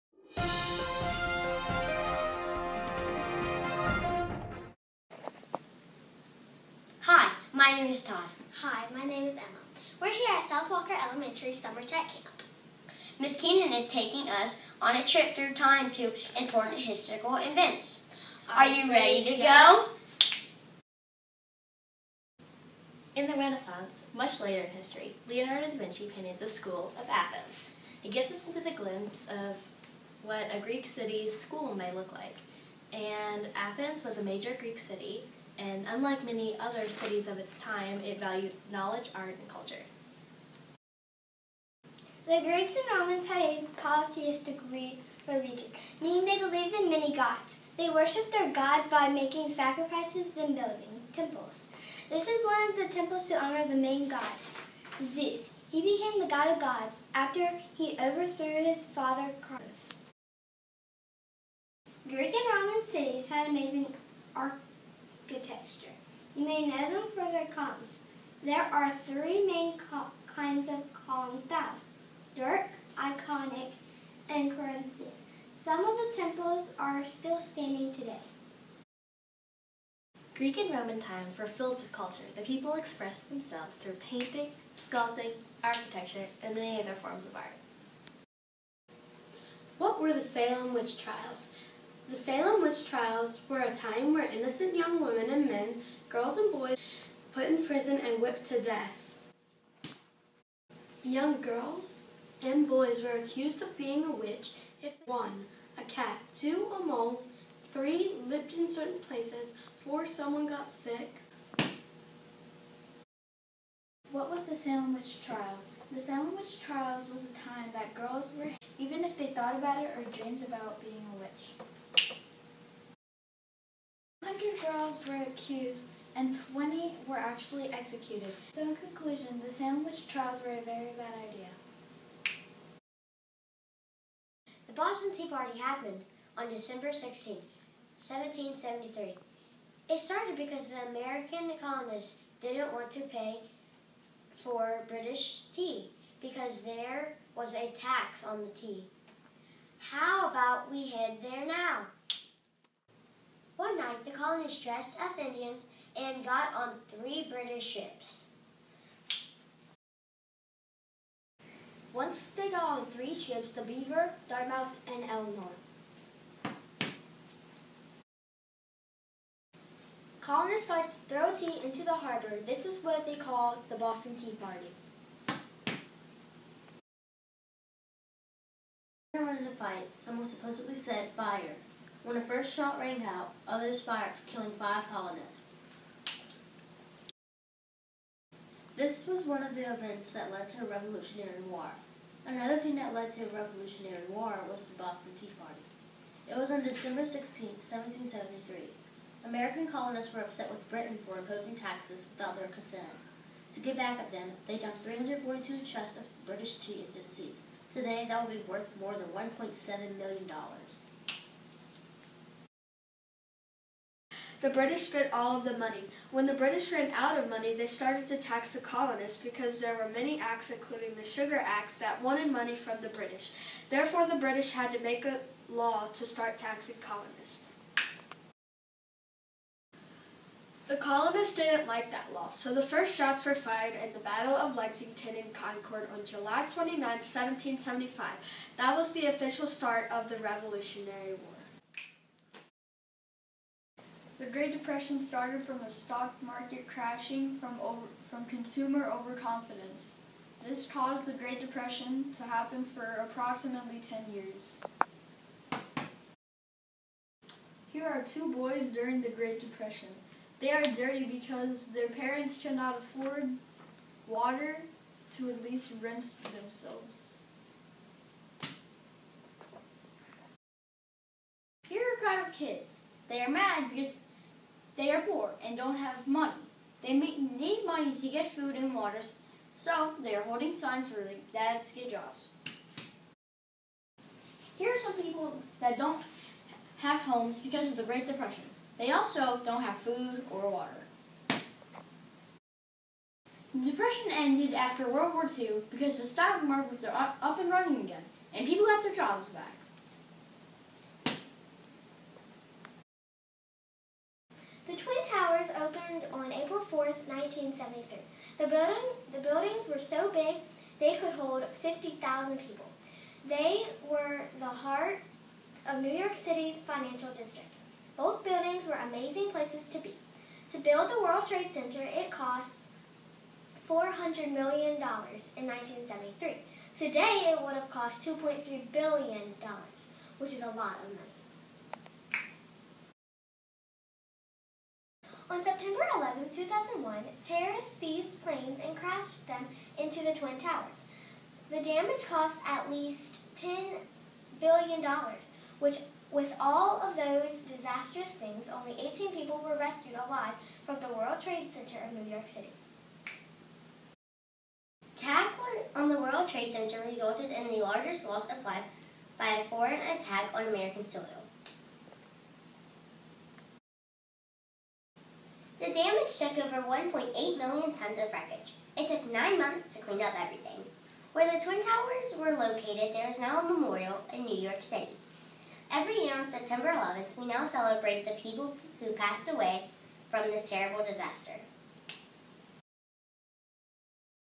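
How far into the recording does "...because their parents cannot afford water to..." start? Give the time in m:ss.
4:21.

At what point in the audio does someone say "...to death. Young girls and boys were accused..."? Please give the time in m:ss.
1:38.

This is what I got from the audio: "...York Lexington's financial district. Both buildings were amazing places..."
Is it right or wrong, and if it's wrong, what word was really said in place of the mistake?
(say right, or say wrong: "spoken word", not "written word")
wrong: "City", not "Lexington".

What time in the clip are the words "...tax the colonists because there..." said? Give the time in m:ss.
3:38.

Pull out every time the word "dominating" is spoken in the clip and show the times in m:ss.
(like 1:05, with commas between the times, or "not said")
not said.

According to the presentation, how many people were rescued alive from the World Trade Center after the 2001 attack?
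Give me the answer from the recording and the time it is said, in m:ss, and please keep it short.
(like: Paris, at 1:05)
18, at 5:48.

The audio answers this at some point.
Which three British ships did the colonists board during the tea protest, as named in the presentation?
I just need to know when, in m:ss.
2:43.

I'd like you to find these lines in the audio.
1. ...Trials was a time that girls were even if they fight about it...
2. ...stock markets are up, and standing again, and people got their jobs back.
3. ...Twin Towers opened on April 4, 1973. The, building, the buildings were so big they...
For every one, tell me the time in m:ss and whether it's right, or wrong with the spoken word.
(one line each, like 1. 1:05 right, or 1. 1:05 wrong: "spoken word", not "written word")
1. 1:56 wrong: "thought", not "fight"
2. 4:56 wrong: "running", not "standing"
3. 5:04 right.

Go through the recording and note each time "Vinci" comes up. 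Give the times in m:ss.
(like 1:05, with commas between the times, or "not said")
0:25.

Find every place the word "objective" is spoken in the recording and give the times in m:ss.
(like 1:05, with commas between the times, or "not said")
not said.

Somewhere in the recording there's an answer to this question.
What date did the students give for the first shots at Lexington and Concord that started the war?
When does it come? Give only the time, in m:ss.
3:56.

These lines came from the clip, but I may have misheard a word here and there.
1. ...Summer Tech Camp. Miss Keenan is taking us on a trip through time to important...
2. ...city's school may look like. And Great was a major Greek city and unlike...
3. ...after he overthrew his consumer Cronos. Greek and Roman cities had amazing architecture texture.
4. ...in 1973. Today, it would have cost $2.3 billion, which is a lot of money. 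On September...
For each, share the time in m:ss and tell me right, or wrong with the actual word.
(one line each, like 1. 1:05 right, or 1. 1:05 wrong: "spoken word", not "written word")
1. 0:11 right
2. 0:30 wrong: "Athens", not "Great"
3. 0:57 wrong: "father", not "consumer"
4. 5:24 right.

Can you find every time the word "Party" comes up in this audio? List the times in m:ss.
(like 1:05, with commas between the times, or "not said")
2:15, 2:54, 3:15.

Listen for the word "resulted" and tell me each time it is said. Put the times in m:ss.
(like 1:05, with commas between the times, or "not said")
5:56.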